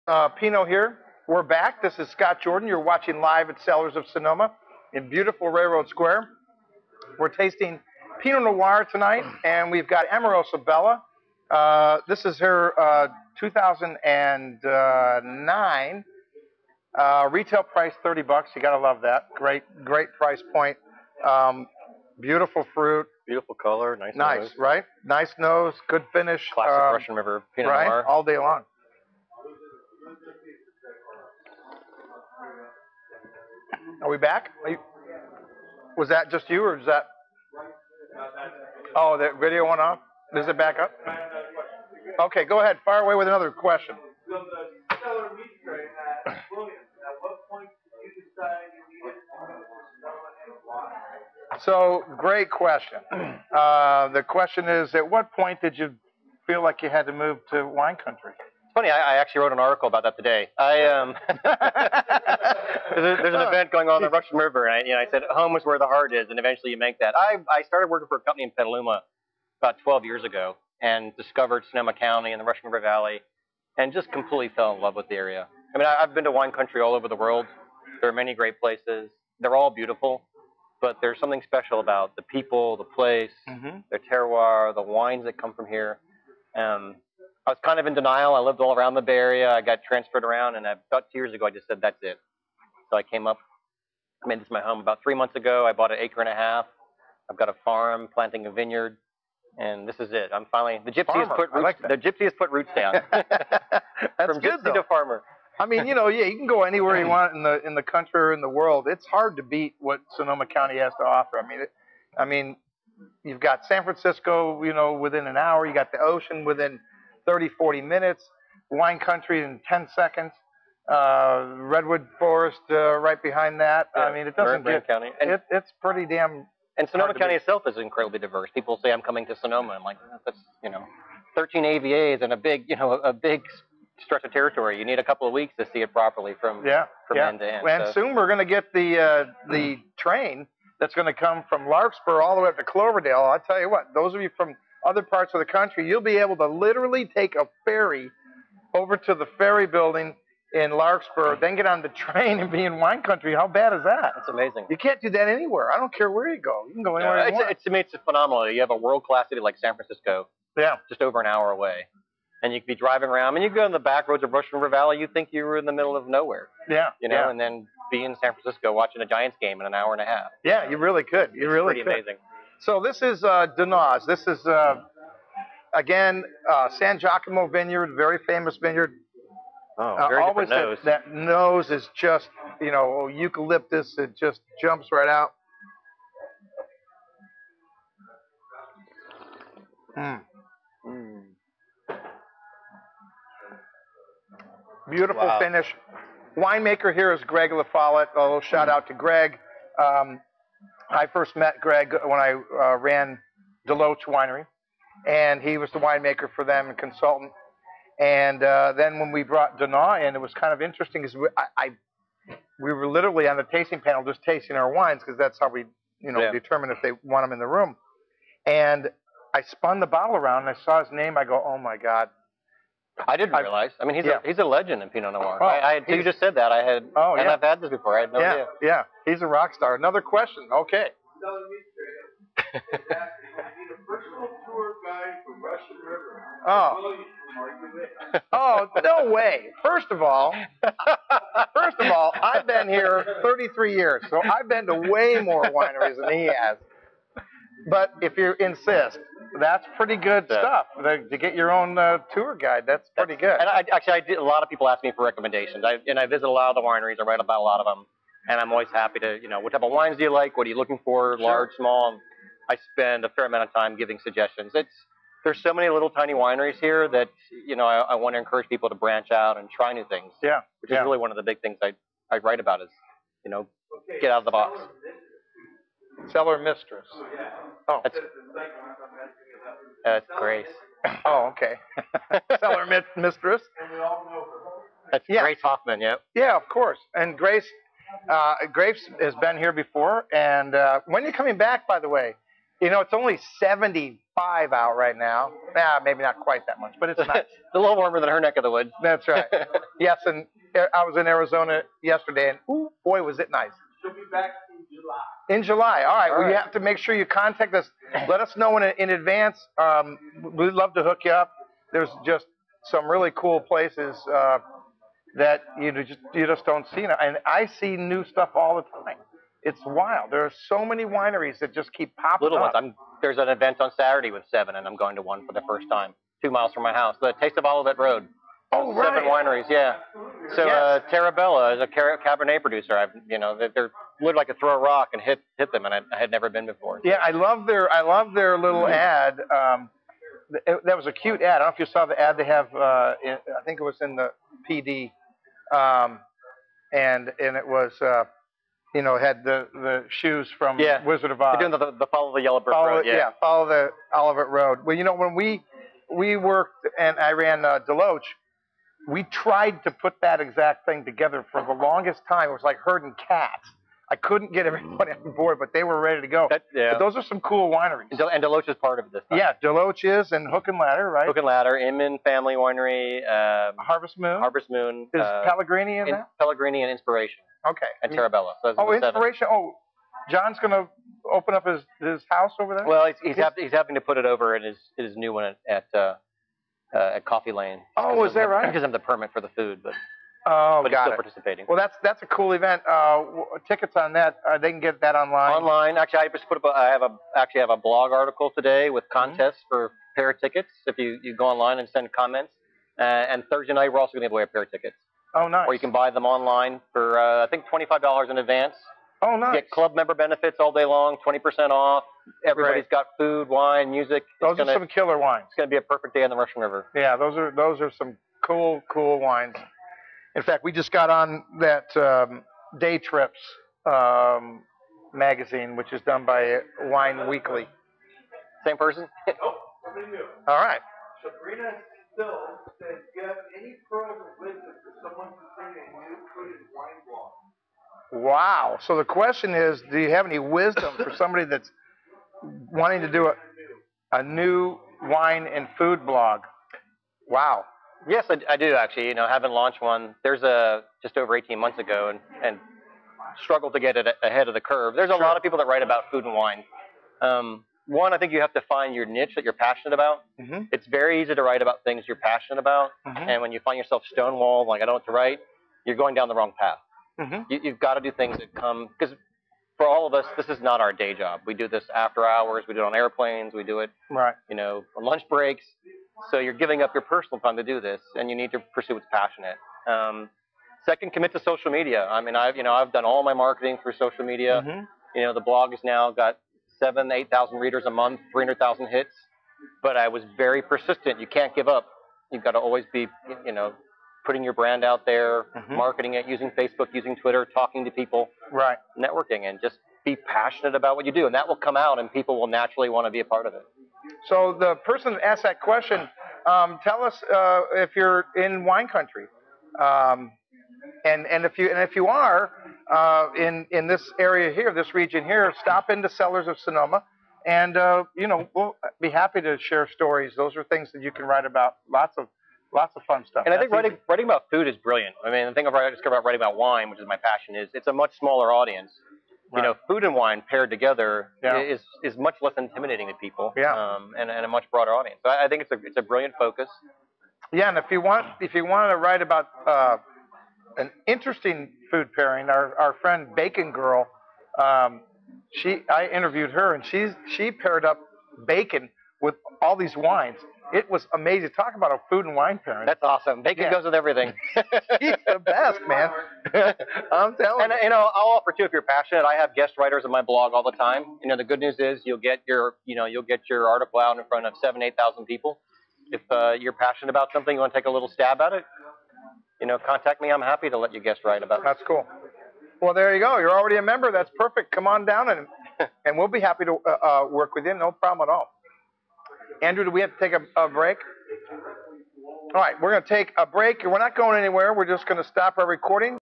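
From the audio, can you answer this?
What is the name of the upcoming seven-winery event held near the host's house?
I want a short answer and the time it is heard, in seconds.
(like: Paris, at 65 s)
The Taste of Olivet Road, at 327 s.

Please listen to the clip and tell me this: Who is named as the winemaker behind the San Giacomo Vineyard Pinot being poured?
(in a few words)
Greg LaFollette.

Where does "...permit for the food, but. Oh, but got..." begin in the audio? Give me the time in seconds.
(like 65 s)
388 s.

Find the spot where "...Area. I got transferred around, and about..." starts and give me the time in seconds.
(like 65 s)
89 s.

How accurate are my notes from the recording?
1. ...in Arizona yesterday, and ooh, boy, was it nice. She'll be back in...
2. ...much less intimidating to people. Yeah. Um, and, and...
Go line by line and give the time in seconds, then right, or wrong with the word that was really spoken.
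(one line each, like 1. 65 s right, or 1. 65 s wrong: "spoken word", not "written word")
1. 300 s right
2. 531 s right.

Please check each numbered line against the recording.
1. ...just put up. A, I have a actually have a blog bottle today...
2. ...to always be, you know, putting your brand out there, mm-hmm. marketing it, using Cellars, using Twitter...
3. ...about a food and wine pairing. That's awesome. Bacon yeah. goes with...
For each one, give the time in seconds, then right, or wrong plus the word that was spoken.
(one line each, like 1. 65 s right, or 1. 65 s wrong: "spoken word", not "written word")
1. 396 s wrong: "article", not "bottle"
2. 492 s wrong: "Facebook", not "Cellars"
3. 551 s right.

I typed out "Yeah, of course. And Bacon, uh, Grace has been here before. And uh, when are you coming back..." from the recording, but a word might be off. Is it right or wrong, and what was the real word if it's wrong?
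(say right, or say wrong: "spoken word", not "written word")
wrong: "Grace", not "Bacon".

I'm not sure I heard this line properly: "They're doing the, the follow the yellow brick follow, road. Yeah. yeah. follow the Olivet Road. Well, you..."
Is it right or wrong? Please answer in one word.
right.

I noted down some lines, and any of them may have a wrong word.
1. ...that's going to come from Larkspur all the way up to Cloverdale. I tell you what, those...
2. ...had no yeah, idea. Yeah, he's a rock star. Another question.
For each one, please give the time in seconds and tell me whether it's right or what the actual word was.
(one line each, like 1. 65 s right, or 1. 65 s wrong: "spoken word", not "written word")
1. 140 s right
2. 228 s right.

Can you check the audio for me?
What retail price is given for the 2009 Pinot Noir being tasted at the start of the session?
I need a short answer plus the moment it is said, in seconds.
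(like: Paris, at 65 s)
$30, at 18 s.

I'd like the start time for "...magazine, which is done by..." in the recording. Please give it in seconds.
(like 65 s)
424 s.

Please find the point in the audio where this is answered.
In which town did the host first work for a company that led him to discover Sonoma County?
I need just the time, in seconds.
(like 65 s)
68 s.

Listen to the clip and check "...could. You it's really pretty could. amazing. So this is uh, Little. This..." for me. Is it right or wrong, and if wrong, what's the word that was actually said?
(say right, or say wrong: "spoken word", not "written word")
wrong: "Dinas", not "Little".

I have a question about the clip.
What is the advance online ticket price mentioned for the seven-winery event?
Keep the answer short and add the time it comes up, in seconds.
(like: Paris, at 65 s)
$25, at 407 s.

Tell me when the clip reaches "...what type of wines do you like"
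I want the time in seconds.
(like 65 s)
259 s.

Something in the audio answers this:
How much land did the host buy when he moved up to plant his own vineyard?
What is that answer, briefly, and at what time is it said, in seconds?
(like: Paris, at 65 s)
An acre and a half, at 95 s.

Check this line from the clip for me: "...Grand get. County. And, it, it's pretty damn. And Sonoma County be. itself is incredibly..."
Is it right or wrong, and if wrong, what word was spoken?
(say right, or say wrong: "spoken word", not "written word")
right.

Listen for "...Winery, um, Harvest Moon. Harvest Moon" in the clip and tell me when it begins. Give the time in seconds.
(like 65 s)
372 s.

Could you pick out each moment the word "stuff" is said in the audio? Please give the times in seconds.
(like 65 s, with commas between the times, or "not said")
250 s, 318 s, 523 s.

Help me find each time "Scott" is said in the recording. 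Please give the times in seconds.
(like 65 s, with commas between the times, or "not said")
2 s.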